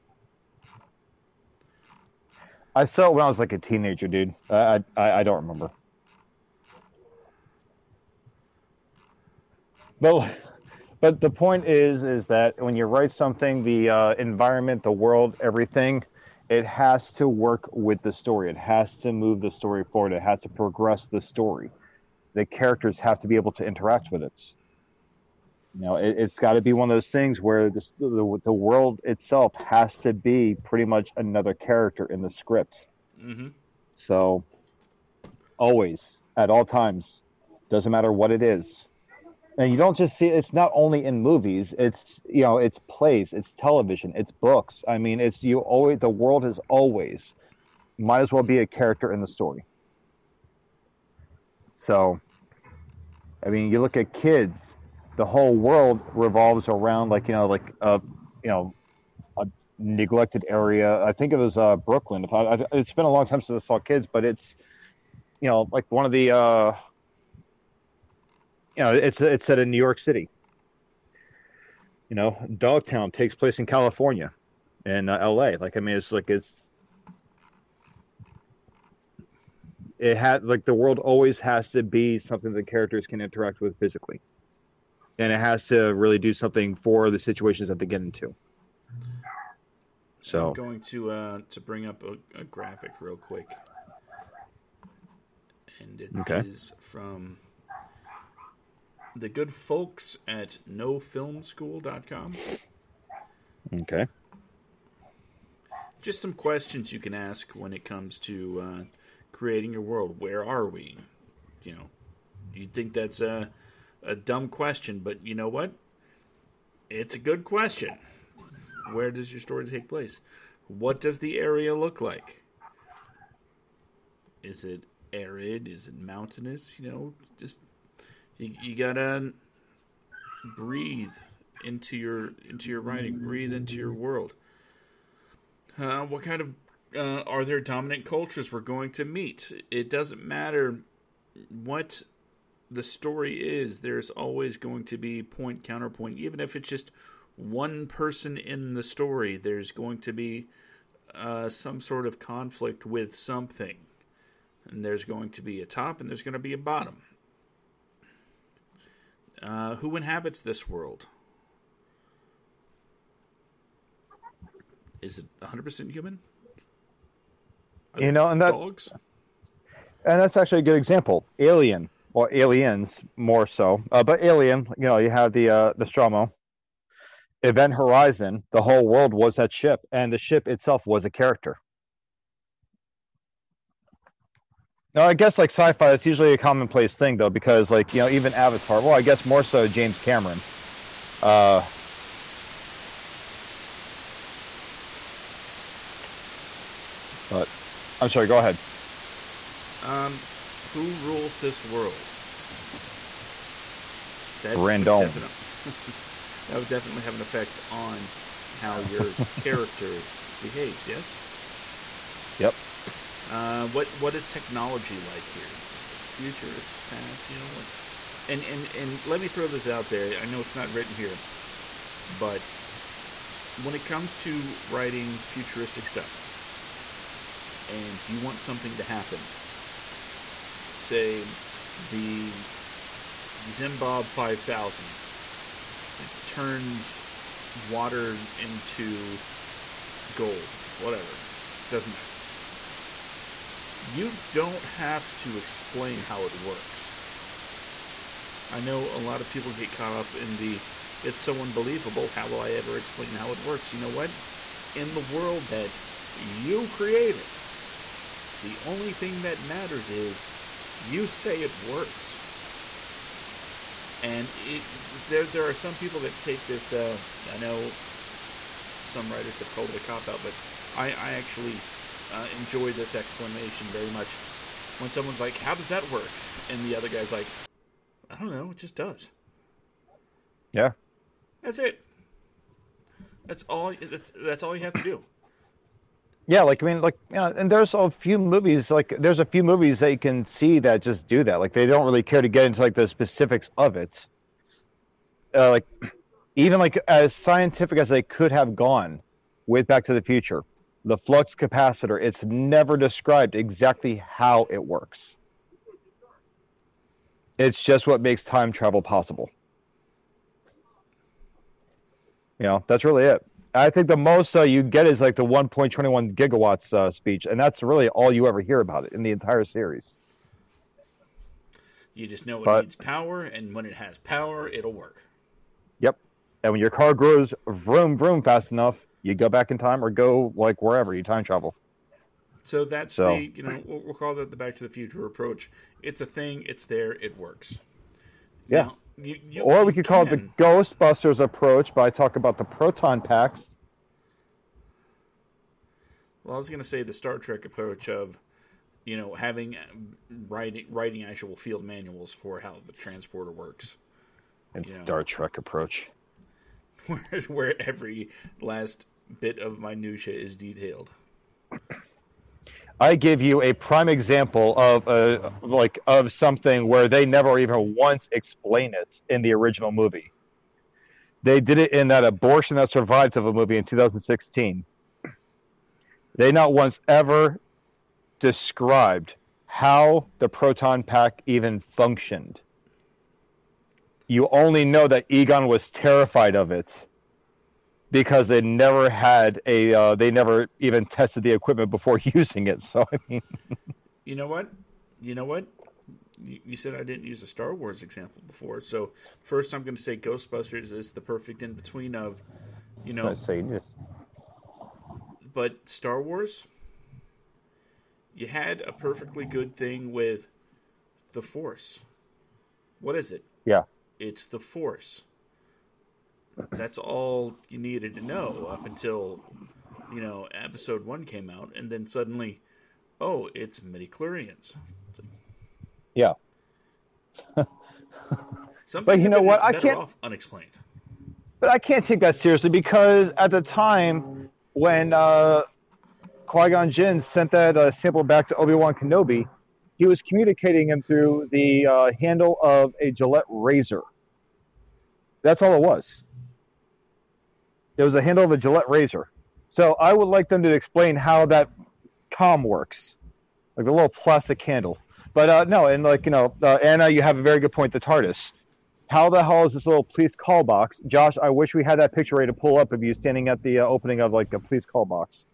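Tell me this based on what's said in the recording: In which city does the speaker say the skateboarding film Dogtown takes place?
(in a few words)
L.A.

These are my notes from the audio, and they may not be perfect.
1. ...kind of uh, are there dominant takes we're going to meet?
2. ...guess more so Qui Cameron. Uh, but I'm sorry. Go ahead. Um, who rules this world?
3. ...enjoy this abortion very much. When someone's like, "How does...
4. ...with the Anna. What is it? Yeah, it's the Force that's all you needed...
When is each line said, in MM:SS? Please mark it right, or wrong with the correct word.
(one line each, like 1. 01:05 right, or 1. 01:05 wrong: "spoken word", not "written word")
1. 02:16 wrong: "cultures", not "takes"
2. 03:09 wrong: "James", not "Qui"
3. 04:32 wrong: "explanation", not "abortion"
4. 06:49 wrong: "Force", not "Anna".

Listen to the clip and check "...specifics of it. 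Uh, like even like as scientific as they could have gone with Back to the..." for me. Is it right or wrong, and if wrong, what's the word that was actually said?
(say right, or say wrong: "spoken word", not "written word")
right.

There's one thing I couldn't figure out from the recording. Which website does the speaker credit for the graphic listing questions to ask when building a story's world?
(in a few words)
nofilmschool.com.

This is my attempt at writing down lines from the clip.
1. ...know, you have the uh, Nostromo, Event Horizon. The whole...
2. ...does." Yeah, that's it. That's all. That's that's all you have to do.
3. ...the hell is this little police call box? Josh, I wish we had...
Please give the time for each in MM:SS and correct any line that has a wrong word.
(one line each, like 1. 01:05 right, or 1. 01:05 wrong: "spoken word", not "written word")
1. 02:54 right
2. 04:38 right
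3. 07:39 right.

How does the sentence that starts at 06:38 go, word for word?
So first, I'm going to say Ghostbusters is the perfect in between of, you know, say just.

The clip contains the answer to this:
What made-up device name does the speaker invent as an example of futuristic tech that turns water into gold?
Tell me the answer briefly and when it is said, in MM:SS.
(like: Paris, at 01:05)
Zimbabwe 5000, at 03:53.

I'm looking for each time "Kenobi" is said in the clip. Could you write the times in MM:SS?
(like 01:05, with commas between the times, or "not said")
07:18.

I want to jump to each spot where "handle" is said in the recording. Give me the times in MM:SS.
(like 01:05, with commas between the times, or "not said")
07:21, 07:28, 07:34.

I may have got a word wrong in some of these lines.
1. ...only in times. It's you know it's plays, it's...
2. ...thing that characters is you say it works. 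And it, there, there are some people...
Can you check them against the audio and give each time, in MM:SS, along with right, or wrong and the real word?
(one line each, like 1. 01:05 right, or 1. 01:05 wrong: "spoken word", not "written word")
1. 00:40 wrong: "movies", not "times"
2. 04:18 wrong: "matters", not "characters".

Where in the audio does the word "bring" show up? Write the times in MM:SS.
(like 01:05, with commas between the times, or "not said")
01:31.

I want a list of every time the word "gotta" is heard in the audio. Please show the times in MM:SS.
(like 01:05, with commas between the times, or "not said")
02:08.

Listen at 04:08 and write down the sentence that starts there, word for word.
I know a lot of people get caught up in the it's so unbelievable, how will I ever explain how it works?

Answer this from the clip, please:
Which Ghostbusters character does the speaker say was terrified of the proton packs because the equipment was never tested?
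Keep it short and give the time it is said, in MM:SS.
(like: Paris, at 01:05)
Egon, at 06:25.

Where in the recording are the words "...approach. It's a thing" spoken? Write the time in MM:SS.
05:35.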